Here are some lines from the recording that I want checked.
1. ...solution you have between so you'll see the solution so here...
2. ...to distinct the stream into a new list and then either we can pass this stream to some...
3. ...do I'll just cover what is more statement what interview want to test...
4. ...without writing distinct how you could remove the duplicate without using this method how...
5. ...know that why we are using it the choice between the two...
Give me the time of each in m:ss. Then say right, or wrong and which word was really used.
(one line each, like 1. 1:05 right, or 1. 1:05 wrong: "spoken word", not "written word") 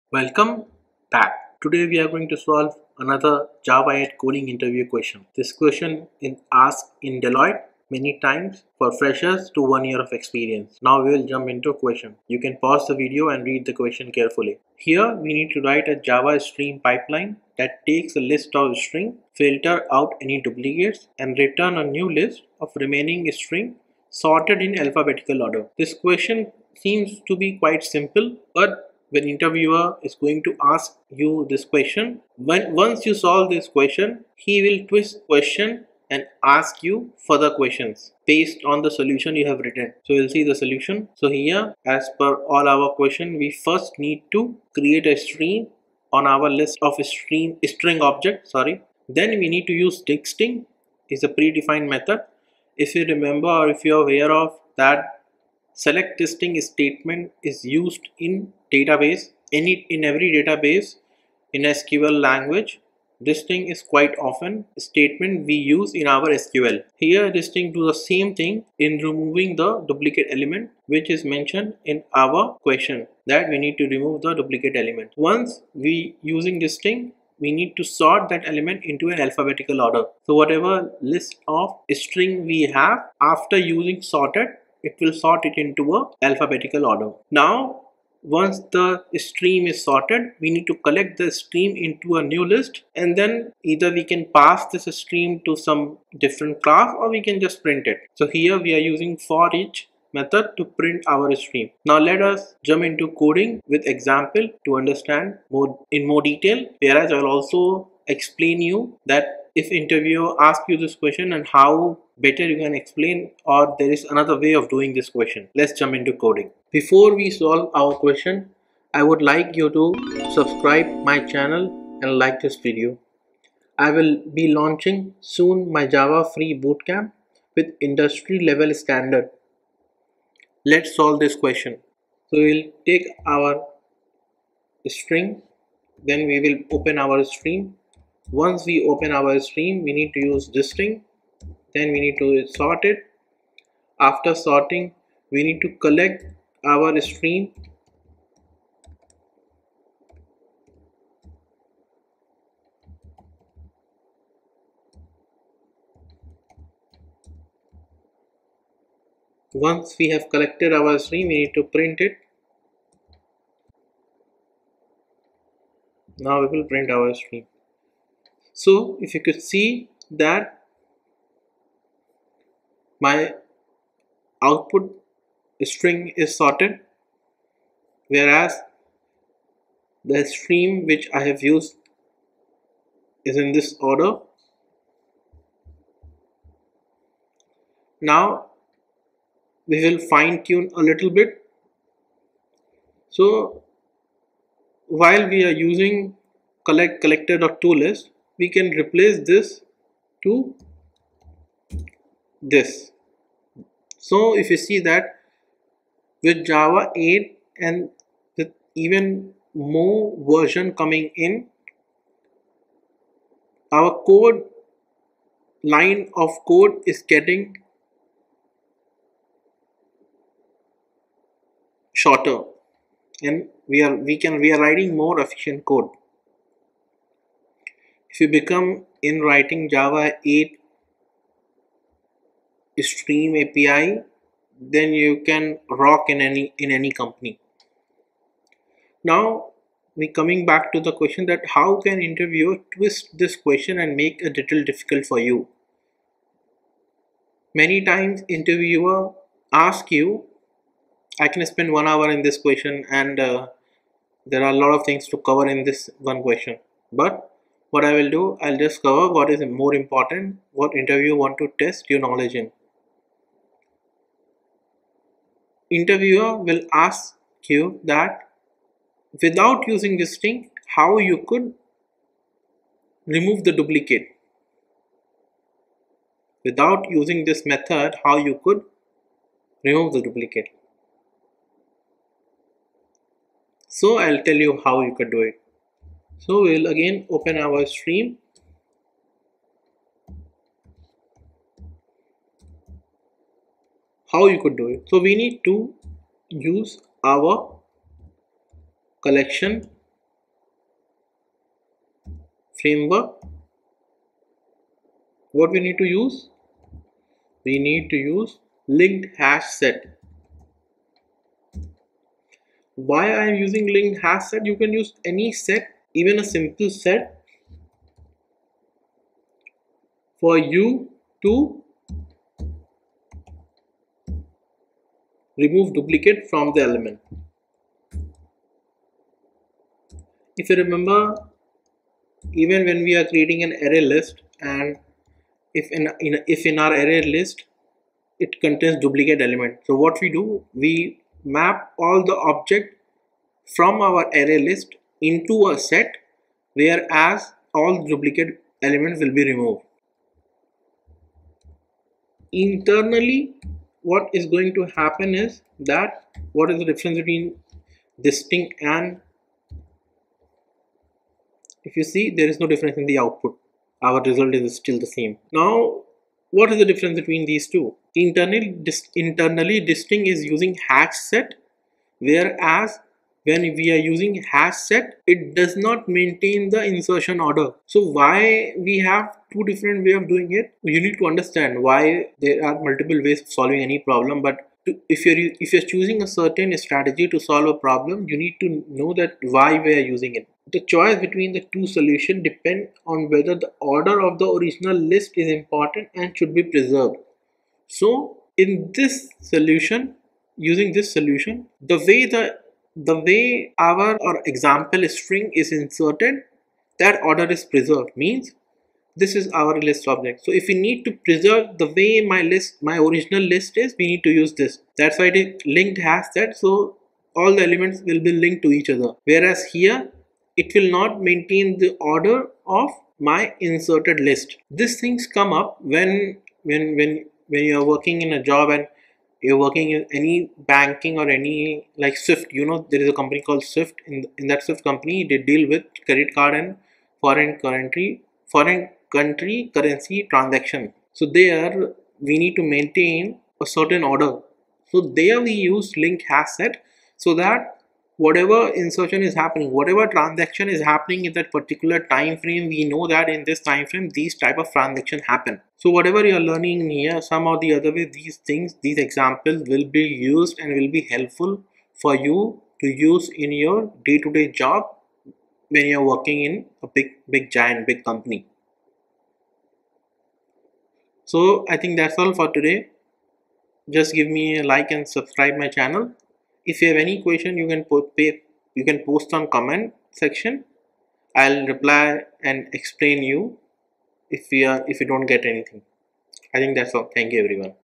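1. 0:38 wrong: "written", not "between"
2. 1:30 wrong: "collect", not "distinct"
3. 4:18 wrong: "important", not "statement"
4. 4:29 wrong: "using", not "writing"
5. 6:28 right.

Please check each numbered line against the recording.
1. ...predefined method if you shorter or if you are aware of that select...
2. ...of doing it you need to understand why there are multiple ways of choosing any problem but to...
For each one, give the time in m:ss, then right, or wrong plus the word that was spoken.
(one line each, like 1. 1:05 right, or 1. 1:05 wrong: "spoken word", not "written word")
1. 0:51 wrong: "remember", not "shorter"
2. 6:19 wrong: "solving", not "choosing".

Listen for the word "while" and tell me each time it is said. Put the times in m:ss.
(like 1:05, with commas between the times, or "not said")
3:14.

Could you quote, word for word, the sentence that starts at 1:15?
Once we using distinct we need to sort that element into an alphabetical order.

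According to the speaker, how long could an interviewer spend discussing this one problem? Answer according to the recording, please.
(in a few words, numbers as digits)
1 hour.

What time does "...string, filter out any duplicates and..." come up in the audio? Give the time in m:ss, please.
0:18.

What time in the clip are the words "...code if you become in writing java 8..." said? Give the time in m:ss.
3:45.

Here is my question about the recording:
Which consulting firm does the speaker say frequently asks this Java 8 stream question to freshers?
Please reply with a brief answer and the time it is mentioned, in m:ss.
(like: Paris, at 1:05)
Deloitte, at 0:07.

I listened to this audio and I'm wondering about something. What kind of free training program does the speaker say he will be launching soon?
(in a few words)
Java free bootcamp.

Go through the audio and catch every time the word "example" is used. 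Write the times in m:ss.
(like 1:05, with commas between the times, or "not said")
1:43, 6:44, 7:38.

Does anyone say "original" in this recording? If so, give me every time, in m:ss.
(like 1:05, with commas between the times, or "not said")
6:34, 6:52.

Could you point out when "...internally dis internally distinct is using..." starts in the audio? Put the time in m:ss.
6:07.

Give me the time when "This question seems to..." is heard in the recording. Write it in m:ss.
0:25.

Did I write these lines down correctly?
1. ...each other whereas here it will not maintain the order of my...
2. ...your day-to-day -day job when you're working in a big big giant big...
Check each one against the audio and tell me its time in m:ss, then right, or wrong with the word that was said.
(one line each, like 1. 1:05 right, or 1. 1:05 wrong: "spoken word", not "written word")
1. 6:58 right
2. 7:43 right.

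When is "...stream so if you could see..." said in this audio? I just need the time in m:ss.
2:47.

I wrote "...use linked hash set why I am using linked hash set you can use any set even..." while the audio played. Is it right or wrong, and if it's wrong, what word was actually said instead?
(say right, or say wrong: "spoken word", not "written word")
right.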